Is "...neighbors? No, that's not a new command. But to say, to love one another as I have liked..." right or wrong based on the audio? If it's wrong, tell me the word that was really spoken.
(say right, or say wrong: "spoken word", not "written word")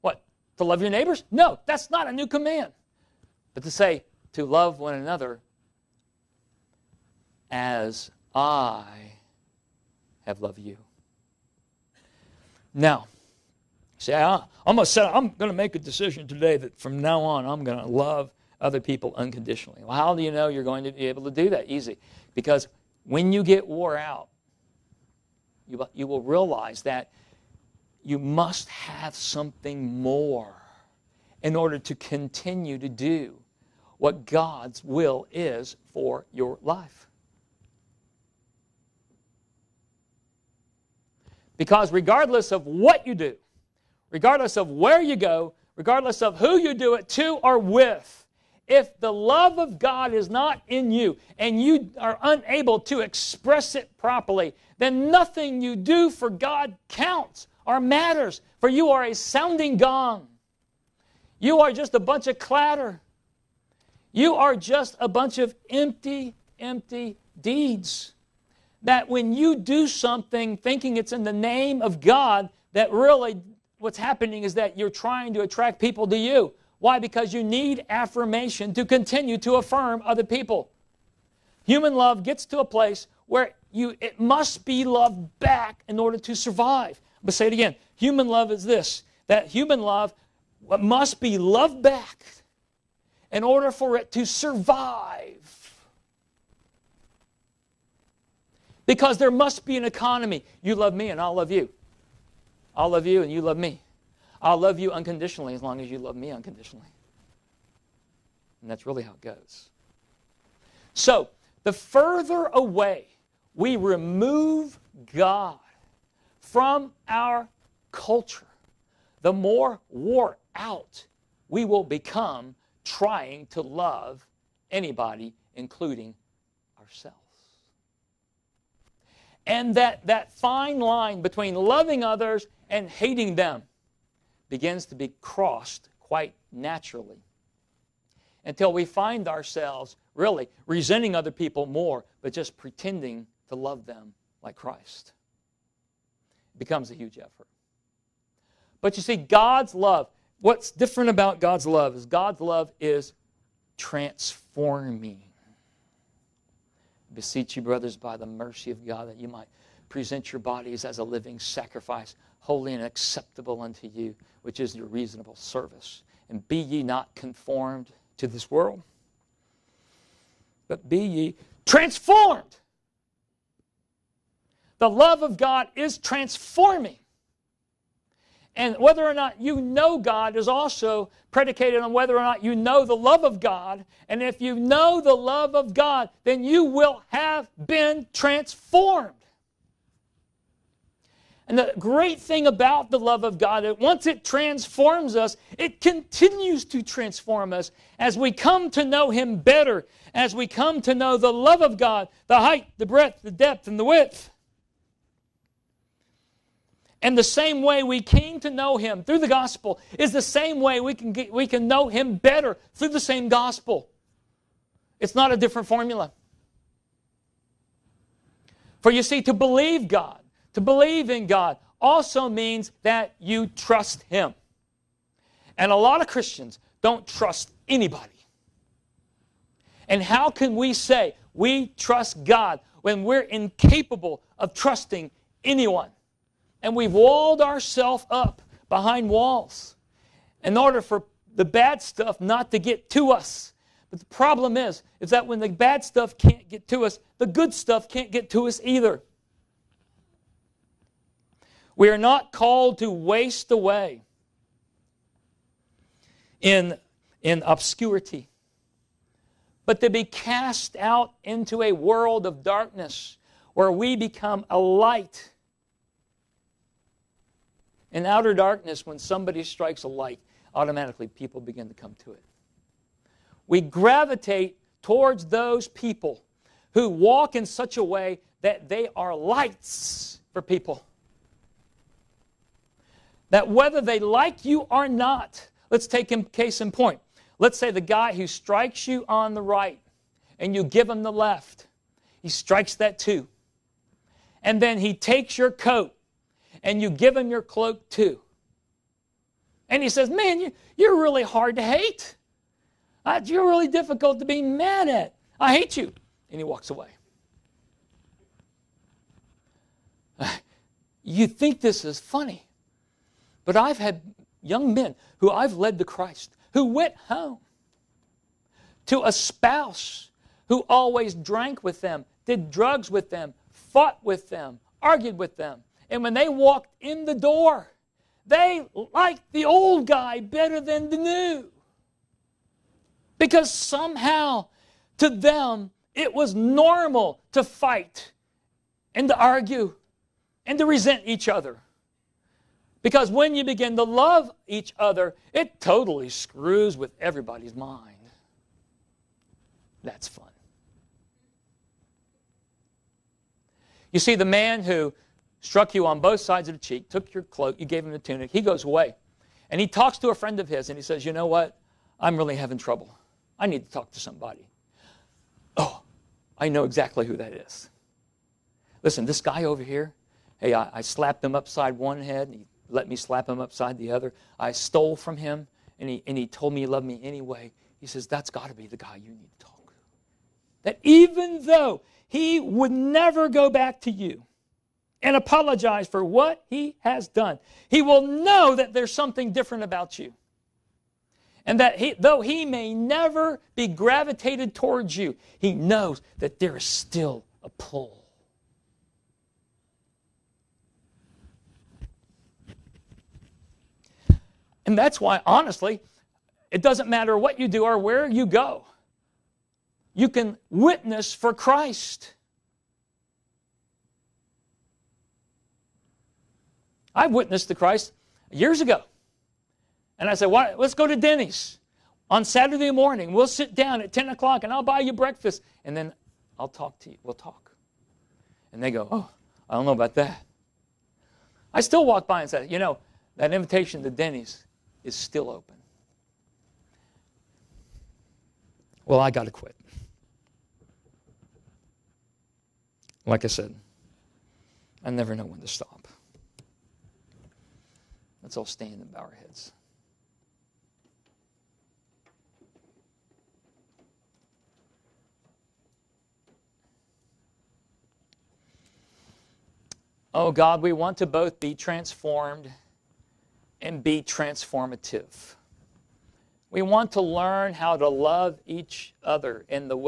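wrong: "loved", not "liked".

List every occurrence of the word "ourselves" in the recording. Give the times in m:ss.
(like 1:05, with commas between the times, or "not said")
2:06, 2:19, 3:57.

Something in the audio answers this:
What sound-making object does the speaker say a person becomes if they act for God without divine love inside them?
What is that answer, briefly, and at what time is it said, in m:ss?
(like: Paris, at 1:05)
sounding gong, at 0:59.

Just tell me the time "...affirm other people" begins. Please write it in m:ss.
1:19.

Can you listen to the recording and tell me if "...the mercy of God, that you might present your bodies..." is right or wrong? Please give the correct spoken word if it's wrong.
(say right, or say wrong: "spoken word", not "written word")
right.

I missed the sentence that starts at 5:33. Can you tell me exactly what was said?
Because somehow to them, it was normal to fight and to argue and to resent each other.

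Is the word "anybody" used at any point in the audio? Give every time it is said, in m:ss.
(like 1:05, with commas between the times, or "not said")
2:04, 3:47.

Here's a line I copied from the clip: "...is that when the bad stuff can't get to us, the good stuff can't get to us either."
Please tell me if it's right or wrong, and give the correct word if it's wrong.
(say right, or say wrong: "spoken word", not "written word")
right.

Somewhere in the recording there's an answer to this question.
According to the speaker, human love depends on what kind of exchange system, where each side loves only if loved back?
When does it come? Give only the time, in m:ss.
1:39.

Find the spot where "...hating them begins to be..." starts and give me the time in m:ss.
2:12.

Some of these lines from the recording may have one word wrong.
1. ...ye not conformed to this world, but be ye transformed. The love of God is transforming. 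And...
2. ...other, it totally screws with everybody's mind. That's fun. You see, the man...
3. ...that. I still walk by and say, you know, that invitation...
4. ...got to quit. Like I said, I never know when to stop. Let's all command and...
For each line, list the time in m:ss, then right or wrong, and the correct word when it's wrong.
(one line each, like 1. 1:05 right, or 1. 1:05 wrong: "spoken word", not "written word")
1. 2:46 right
2. 5:44 right
3. 7:09 right
4. 7:19 wrong: "stand", not "command".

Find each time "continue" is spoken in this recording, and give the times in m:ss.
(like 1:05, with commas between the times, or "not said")
0:31, 1:18, 3:15.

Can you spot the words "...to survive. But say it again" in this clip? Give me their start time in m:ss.
1:26.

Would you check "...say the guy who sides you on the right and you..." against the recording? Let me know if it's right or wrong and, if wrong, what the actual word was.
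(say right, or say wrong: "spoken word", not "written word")
wrong: "strikes", not "sides".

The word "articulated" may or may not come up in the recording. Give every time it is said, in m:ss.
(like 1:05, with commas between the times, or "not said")
not said.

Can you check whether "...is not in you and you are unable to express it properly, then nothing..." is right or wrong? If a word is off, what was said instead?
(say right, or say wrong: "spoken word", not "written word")
right.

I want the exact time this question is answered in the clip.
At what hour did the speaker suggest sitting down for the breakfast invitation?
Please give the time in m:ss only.
7:03.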